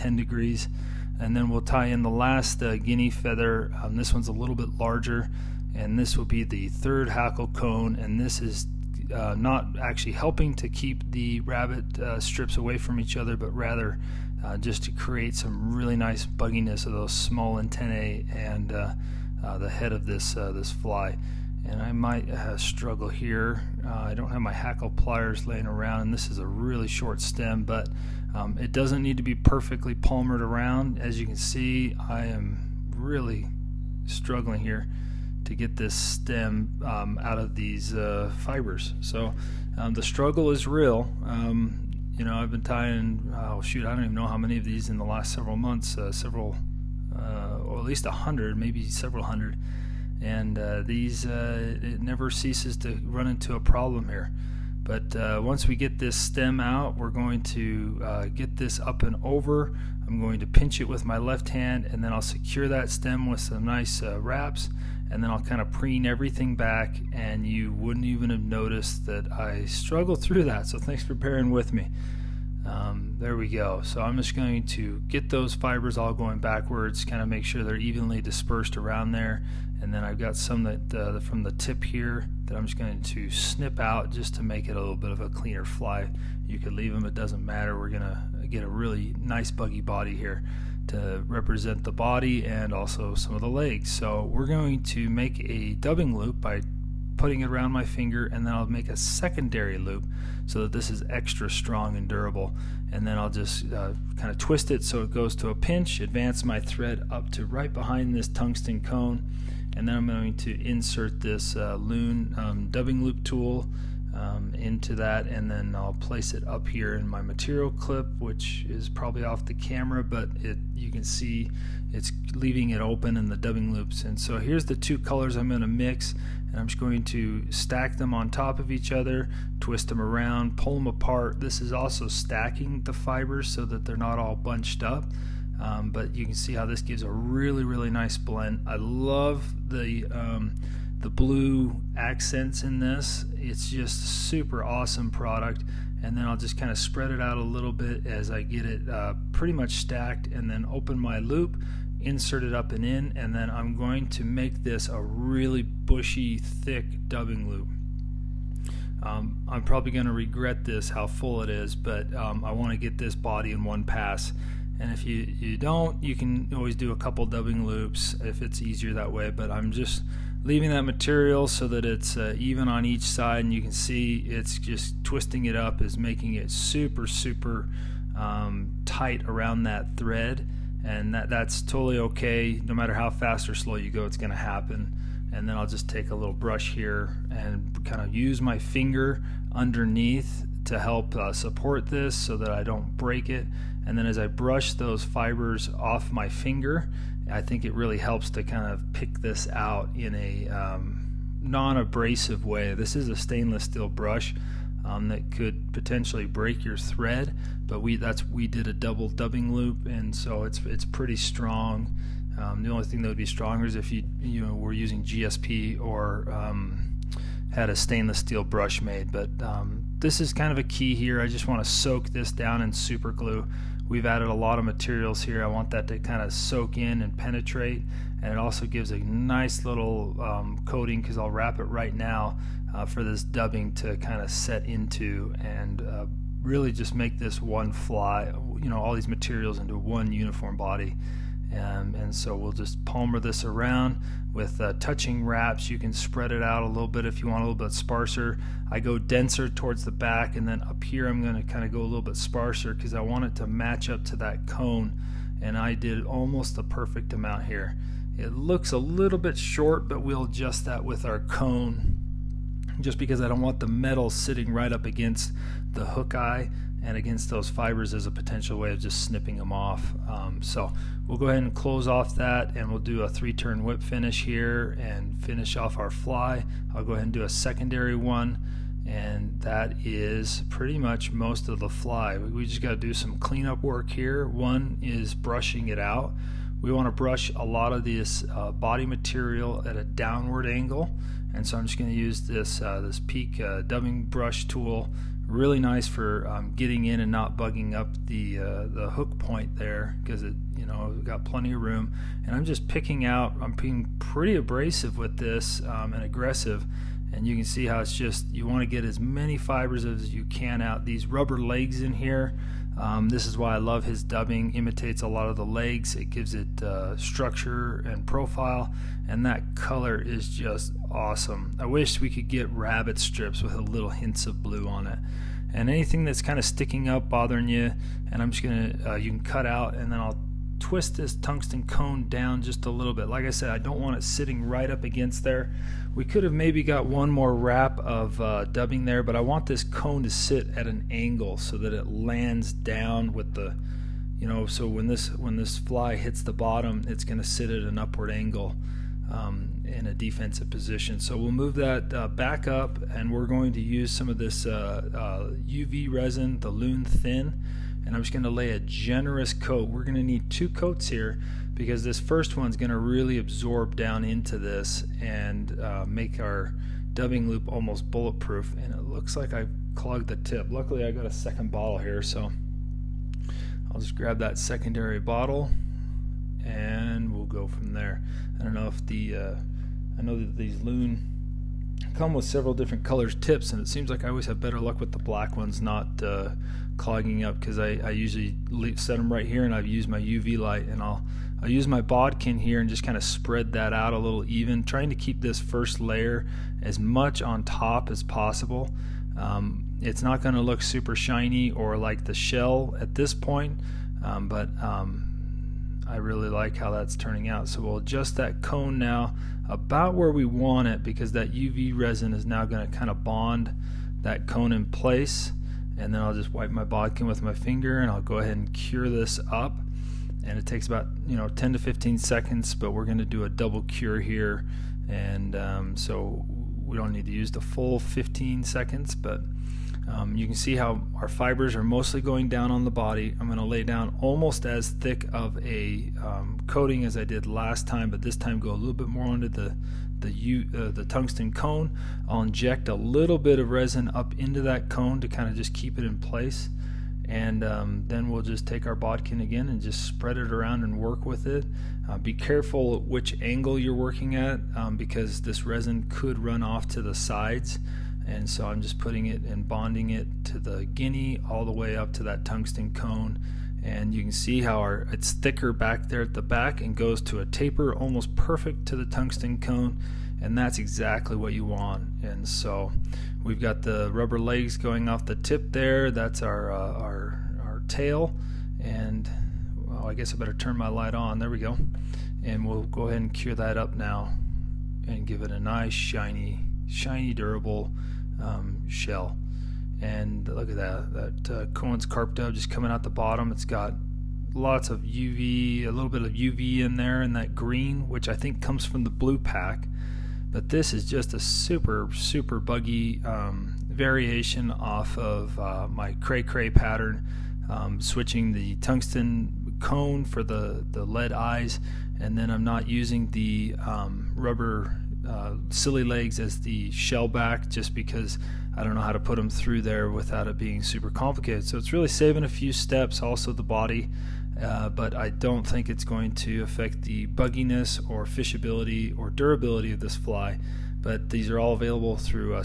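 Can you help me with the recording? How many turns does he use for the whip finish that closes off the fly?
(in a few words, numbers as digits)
3.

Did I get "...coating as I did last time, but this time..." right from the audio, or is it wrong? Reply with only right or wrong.
right.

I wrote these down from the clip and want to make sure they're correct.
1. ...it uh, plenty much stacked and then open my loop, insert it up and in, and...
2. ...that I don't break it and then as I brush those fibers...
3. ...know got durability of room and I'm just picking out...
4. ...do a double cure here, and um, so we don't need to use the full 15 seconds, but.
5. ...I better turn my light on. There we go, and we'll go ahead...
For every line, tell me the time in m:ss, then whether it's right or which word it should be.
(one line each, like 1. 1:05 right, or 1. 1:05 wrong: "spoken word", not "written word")
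1. 2:28 wrong: "pretty", not "plenty"
2. 3:12 right
3. 5:00 wrong: "plenty", not "durability"
4. 7:03 right
5. 8:00 right.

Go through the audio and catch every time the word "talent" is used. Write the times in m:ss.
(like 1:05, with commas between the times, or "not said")
not said.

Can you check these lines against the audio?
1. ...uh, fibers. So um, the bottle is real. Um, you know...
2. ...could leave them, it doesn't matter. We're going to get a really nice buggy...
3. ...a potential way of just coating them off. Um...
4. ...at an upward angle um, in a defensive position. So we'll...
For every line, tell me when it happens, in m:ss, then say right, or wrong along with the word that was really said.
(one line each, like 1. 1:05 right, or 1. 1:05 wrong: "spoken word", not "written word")
1. 0:37 wrong: "struggle", not "bottle"
2. 1:26 right
3. 4:28 wrong: "snipping", not "coating"
4. 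5:47 right.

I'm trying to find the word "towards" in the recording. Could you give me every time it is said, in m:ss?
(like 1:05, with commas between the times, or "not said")
4:09.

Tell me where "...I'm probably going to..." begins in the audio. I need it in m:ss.
2:39.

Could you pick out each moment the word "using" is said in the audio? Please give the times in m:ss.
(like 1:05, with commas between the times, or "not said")
3:34, 8:32.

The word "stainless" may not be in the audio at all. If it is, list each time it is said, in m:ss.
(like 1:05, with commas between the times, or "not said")
3:23, 3:37.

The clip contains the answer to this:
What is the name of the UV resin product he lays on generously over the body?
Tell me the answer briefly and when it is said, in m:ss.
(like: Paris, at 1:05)
Loon Thin, at 5:56.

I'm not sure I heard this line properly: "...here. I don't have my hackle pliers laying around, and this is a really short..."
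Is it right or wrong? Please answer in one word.
right.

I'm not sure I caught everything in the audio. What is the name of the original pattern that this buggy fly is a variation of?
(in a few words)
cray cray.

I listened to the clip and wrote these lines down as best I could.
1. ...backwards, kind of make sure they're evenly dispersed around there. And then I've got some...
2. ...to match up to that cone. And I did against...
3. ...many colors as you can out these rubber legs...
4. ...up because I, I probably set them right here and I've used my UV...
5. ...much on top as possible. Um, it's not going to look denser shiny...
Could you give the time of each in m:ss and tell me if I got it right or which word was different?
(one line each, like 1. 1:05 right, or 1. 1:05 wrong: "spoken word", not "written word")
1. 1:16 right
2. 4:13 wrong: "almost", not "against"
3. 5:08 wrong: "fibers", not "colors"
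4. 6:27 wrong: "usually", not "probably"
5. 6:36 wrong: "super", not "denser".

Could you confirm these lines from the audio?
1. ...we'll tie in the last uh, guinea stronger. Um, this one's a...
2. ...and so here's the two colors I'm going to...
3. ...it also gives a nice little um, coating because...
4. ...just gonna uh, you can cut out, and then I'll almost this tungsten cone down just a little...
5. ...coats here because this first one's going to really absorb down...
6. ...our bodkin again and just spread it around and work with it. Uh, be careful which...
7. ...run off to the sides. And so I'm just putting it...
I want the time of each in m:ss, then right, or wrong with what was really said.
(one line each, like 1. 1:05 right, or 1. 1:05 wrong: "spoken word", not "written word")
1. 0:01 wrong: "feather", not "stronger"
2. 2:04 right
3. 3:48 right
4. 5:28 wrong: "twist", not "almost"
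5. 6:00 right
6. 7:28 right
7. 7:36 right.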